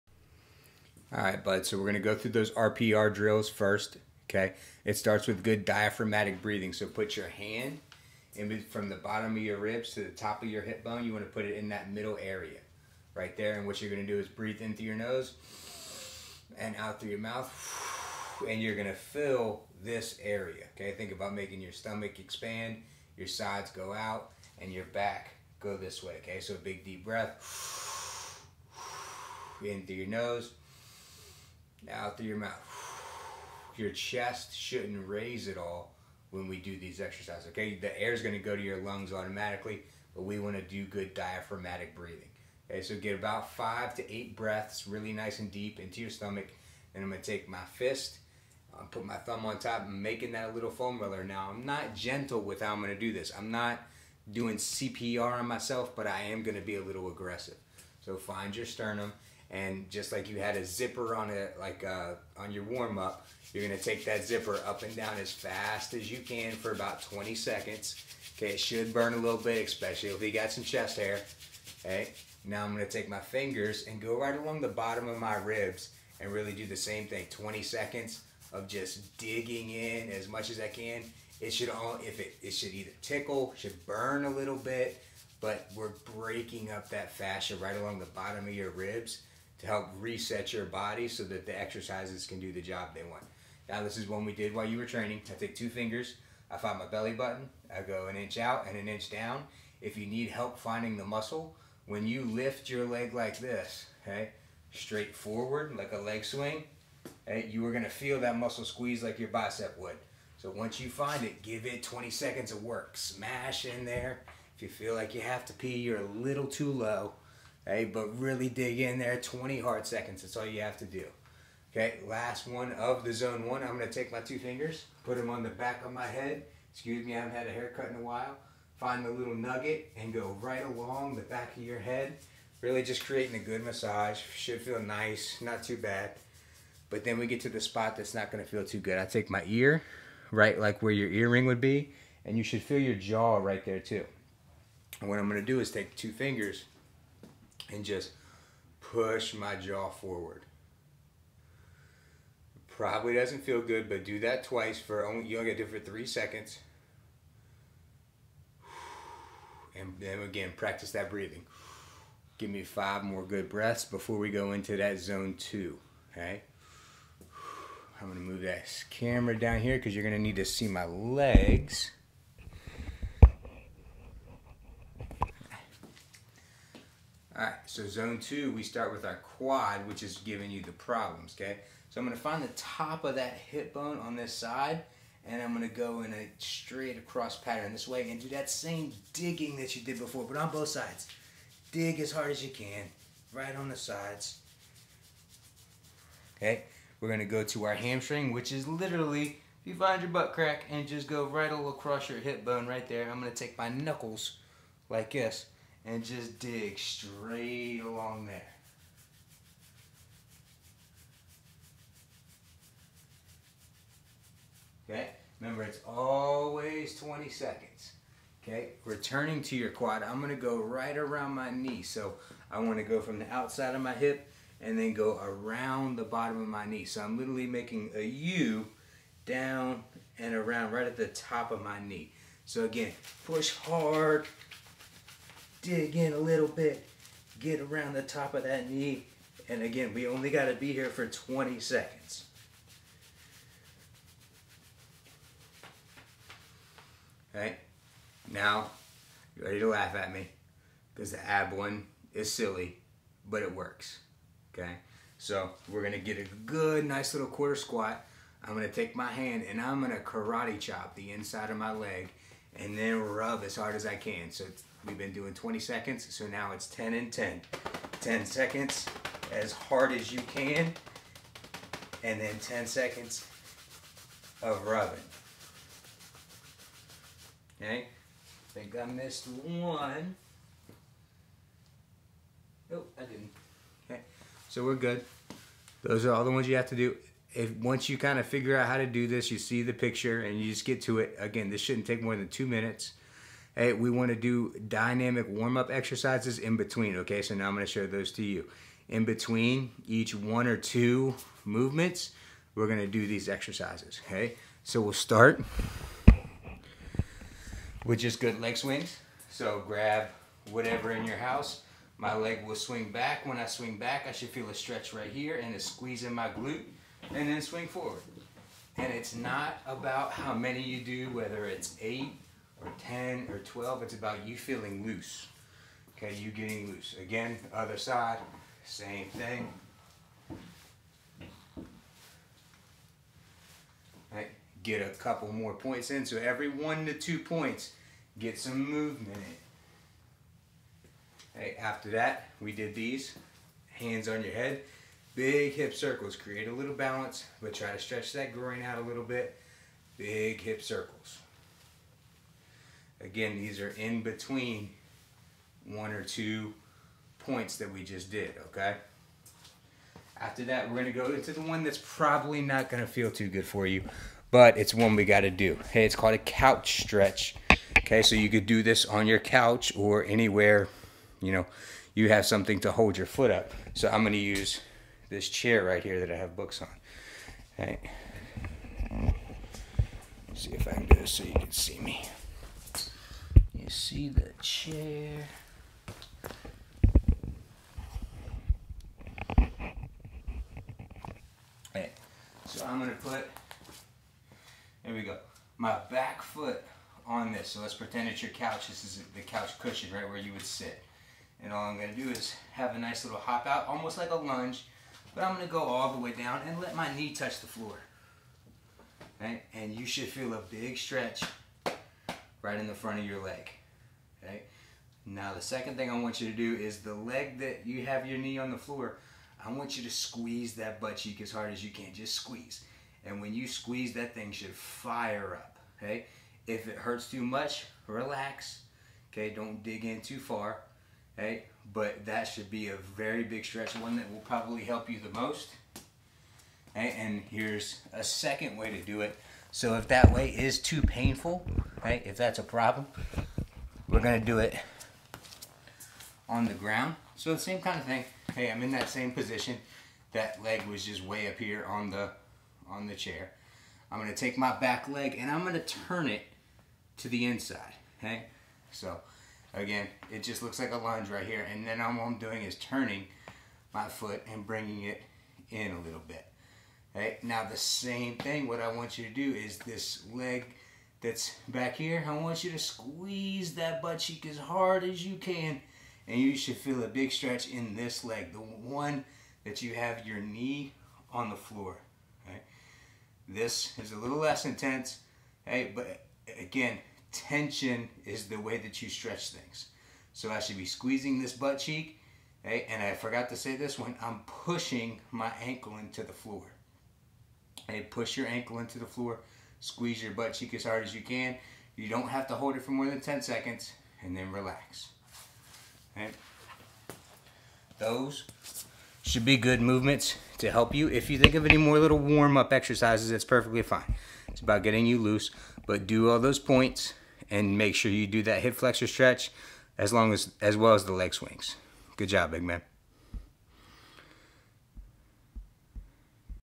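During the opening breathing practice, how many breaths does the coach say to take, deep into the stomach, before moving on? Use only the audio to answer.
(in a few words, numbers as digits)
5 to 8.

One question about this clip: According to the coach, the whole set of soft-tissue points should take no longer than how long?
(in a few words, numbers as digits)
2 minutes.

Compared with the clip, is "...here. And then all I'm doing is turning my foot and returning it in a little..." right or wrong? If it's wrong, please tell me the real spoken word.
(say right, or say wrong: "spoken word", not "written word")
wrong: "bringing", not "returning".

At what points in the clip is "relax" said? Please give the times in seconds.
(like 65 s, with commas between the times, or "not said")
427 s, 504 s.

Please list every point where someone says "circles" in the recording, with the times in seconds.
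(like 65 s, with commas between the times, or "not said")
345 s, 350 s.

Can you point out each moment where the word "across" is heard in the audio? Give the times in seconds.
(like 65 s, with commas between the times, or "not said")
186 s, 201 s.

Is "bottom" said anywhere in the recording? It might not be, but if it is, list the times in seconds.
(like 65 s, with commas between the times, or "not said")
8 s, 74 s, 88 s, 226 s.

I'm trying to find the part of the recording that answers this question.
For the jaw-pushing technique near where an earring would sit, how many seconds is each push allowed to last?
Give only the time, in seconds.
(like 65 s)
155 s.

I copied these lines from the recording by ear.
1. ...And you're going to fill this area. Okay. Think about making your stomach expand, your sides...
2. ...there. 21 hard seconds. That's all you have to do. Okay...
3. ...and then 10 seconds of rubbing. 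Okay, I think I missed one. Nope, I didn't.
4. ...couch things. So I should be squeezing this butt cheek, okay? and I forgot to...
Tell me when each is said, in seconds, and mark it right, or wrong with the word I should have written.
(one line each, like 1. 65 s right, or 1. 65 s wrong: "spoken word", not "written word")
1. 18 s right
2. 118 s wrong: "20", not "21"
3. 272 s right
4. 488 s wrong: "stretch", not "couch".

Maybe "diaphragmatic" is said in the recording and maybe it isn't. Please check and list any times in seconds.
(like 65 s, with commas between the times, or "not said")
5 s, 41 s.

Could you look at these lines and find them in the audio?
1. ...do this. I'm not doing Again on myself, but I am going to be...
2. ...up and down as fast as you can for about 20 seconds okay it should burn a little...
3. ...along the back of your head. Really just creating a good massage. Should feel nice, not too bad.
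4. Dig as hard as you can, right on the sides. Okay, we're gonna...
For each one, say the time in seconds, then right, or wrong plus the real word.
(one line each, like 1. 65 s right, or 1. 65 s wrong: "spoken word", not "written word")
1. 52 s wrong: "CPR", not "Again"
2. 64 s right
3. 130 s right
4. 191 s right.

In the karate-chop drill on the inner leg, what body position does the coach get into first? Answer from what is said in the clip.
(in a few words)
Quarter squat.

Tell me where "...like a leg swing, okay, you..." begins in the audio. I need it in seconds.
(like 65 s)
105 s.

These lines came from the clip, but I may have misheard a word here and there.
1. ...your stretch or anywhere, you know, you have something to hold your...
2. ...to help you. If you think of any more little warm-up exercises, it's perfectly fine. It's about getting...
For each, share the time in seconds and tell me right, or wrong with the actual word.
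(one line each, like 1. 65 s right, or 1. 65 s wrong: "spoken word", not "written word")
1. 369 s wrong: "couch", not "stretch"
2. 510 s right.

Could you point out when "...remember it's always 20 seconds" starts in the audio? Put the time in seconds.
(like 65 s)
215 s.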